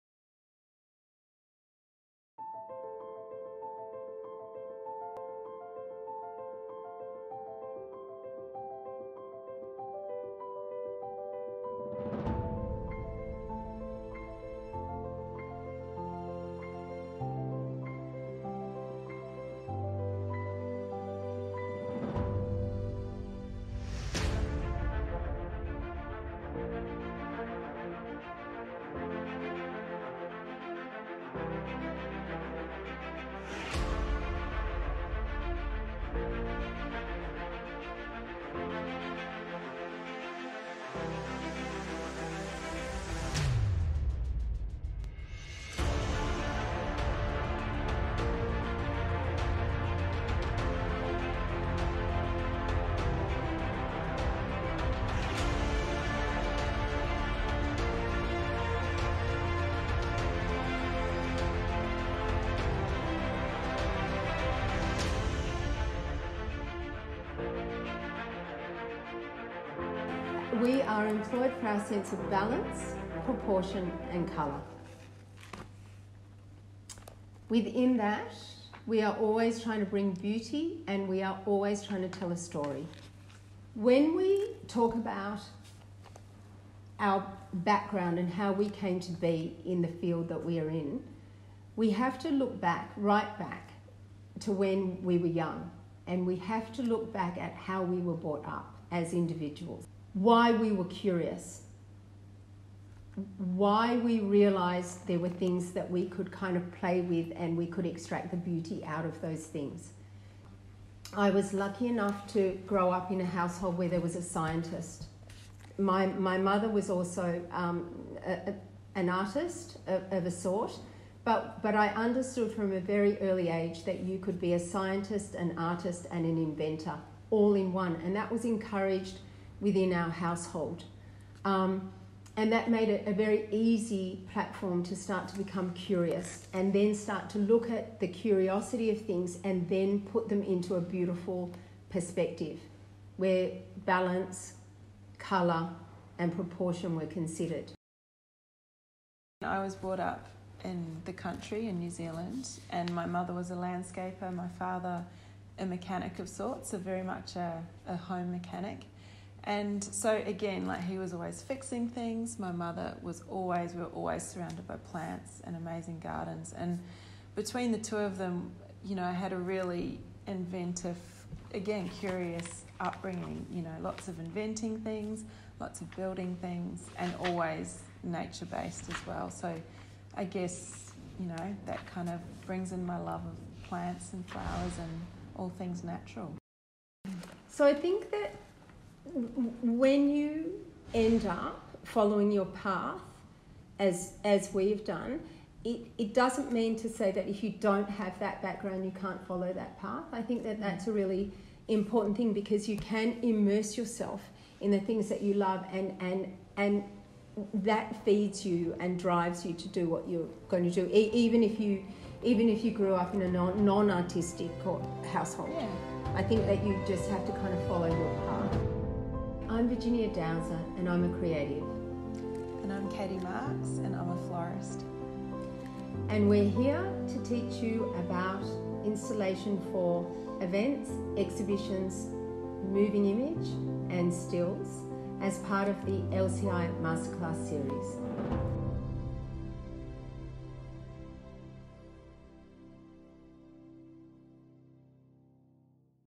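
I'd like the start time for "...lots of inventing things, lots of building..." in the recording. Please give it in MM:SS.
02:53.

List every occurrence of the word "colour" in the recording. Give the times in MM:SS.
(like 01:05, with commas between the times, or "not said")
01:14, 02:25.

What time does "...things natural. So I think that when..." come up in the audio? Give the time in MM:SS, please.
03:05.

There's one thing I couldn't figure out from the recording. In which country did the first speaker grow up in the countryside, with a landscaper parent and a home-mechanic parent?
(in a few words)
New Zealand.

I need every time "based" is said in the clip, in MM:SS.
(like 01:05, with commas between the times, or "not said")
02:58.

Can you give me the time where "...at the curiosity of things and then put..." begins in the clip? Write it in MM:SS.
02:17.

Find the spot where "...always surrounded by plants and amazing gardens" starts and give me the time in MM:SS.
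02:43.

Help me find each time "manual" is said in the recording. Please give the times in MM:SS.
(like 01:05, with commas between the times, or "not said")
not said.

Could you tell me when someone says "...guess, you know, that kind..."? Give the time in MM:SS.
03:00.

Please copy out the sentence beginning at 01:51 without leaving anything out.
I was lucky enough to grow up in a household where there was a scientist.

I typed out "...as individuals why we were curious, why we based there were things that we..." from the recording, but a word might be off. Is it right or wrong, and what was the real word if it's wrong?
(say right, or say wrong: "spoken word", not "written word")
wrong: "realized", not "based".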